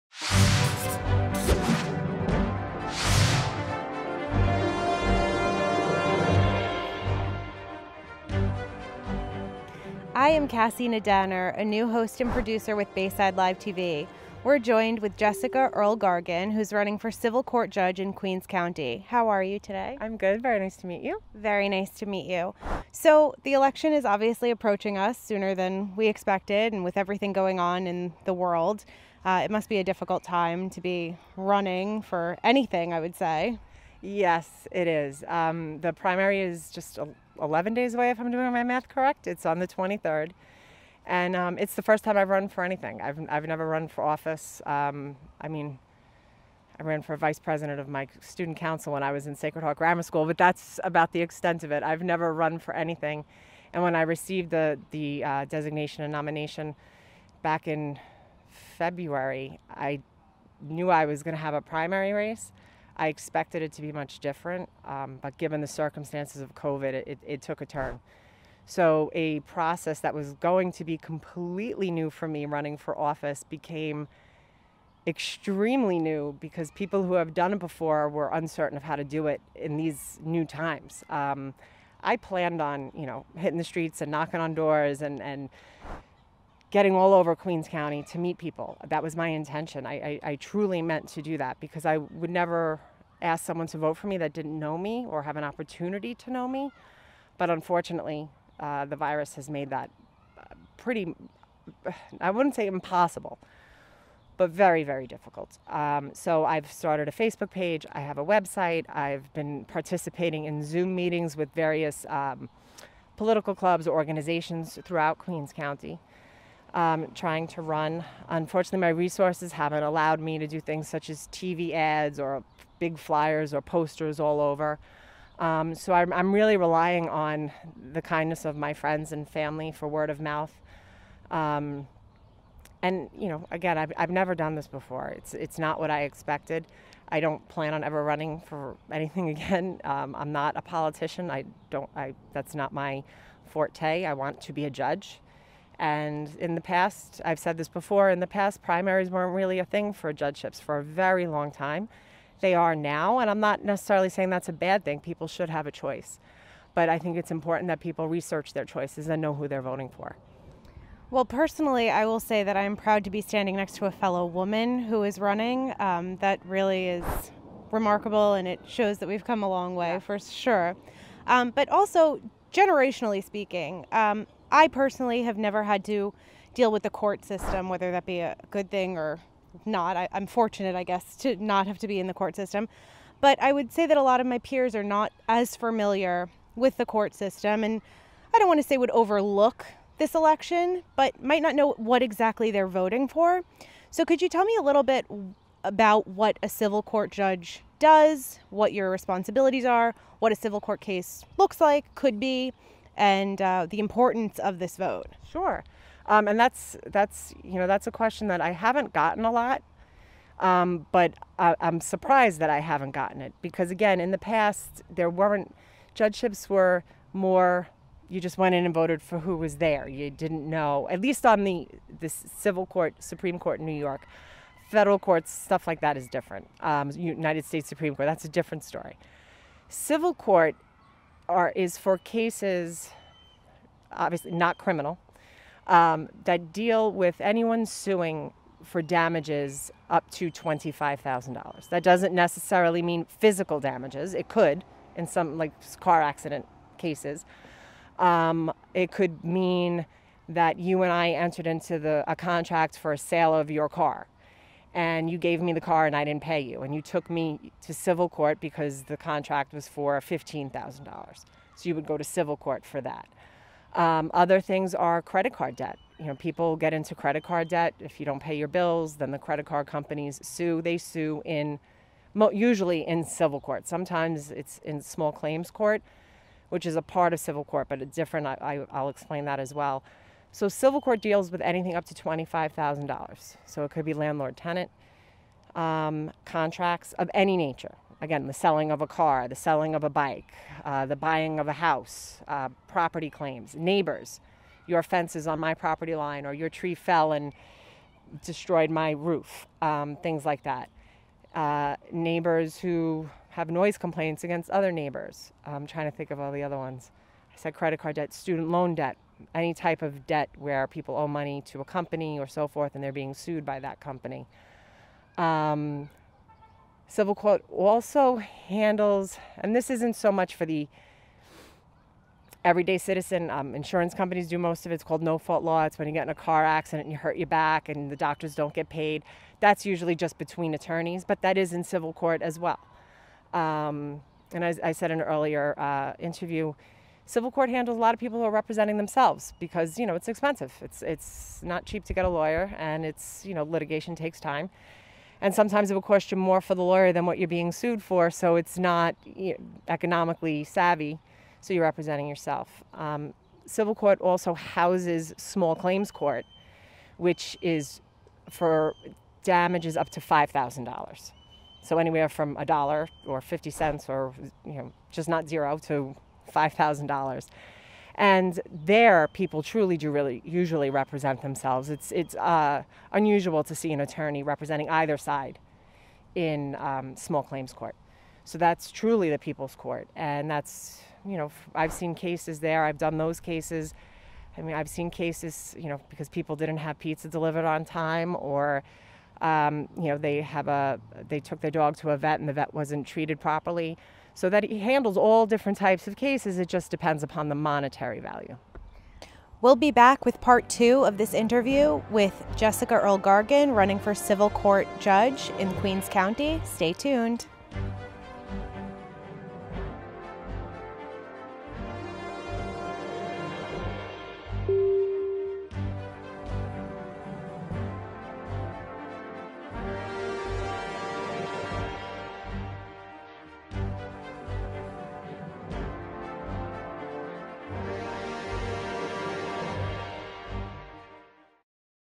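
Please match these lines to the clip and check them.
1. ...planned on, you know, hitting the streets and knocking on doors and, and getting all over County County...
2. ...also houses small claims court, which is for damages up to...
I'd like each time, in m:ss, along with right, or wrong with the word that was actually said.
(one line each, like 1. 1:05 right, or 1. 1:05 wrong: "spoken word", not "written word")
1. 1:22 wrong: "Queens", not "County"
2. 5:53 right.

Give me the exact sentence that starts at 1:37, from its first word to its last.
But unfortunately, uh, the virus has made that uh, pretty, I wouldn't say impossible, but very, very difficult.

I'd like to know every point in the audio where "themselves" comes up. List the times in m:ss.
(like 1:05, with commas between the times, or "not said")
5:38, 6:11.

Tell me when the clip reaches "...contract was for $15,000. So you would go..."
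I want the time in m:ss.
4:18.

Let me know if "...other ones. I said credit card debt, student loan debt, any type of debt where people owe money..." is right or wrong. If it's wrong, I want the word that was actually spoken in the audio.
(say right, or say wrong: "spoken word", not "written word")
right.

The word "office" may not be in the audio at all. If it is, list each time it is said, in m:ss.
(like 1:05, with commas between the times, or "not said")
0:44, 1:12.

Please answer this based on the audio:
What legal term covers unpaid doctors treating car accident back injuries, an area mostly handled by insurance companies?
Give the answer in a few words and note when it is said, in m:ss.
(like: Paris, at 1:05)
no fault law, at 5:25.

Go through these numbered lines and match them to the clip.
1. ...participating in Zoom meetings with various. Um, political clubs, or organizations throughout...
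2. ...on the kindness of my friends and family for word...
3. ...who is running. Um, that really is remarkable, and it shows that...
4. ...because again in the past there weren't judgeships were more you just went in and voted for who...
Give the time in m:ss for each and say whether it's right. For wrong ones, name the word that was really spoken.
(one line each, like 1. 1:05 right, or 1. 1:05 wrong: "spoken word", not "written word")
1. 1:49 right
2. 2:07 right
3. 2:44 right
4. 3:33 right.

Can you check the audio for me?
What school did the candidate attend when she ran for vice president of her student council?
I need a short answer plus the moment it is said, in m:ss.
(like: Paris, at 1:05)
Sacred Heart Grammar School, at 0:49.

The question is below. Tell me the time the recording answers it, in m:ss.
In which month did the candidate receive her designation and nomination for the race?
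0:58.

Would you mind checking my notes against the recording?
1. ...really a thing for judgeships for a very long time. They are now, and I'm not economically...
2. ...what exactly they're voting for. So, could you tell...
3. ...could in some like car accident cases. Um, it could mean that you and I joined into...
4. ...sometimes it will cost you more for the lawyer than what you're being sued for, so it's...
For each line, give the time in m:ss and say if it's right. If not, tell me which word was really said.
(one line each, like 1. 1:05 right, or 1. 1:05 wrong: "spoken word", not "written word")
1. 2:29 wrong: "necessarily", not "economically"
2. 3:11 right
3. 4:04 wrong: "entered", not "joined"
4. 5:45 right.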